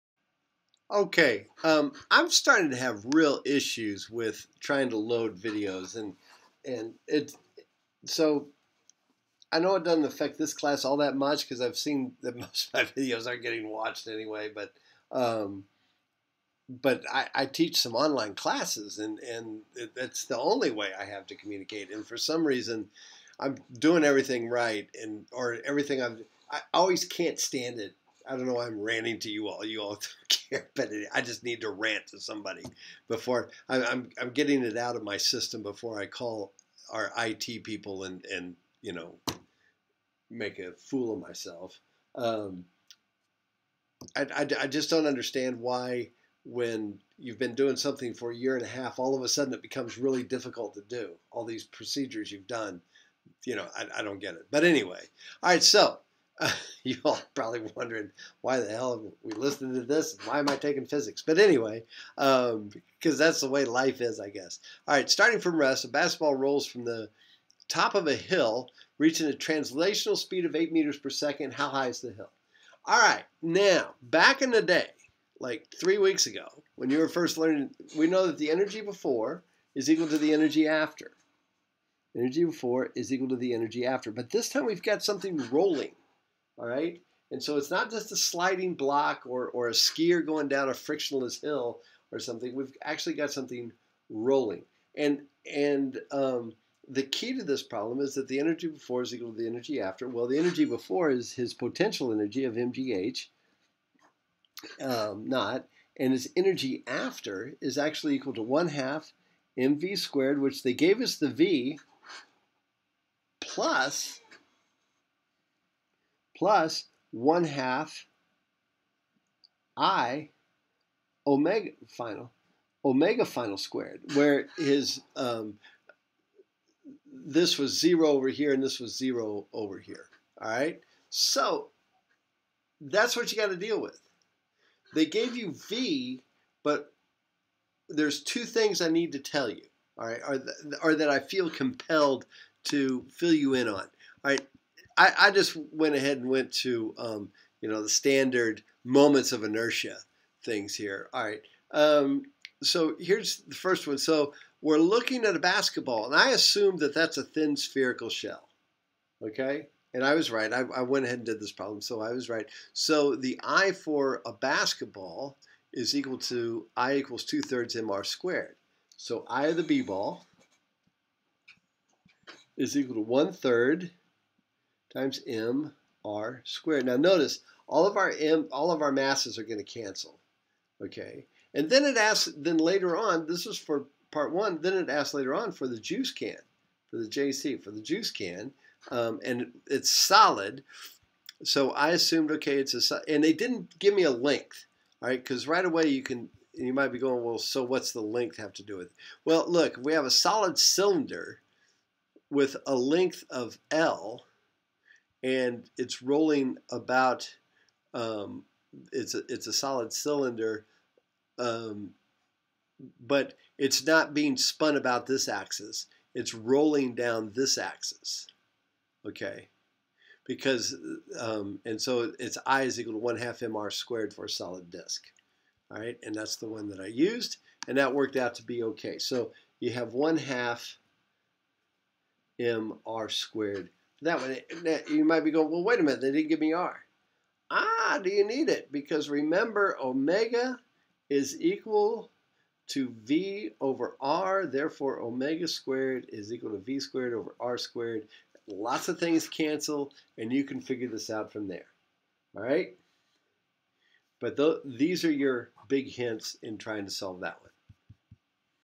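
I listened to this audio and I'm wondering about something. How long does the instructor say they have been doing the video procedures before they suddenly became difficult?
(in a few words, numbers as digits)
a year and a half.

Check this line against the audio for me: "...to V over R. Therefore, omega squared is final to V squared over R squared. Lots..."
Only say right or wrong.
wrong.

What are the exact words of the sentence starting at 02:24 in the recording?
All right, I, I just went ahead and went to um, you know the standard moments of inertia things here.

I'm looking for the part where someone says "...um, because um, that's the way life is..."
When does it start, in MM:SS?
01:02.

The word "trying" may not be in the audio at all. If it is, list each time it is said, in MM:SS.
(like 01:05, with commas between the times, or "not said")
00:04, 04:16.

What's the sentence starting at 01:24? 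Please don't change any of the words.
But this time we've got something rolling.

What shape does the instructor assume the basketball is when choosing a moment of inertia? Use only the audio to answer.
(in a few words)
thin spherical shell.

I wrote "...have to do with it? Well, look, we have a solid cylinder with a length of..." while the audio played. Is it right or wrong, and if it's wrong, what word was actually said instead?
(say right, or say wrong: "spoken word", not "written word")
right.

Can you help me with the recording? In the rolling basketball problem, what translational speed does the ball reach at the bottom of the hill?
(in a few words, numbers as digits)
8 meters per second.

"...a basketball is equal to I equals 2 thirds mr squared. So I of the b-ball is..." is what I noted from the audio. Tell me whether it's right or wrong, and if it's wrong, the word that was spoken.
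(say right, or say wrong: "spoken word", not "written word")
right.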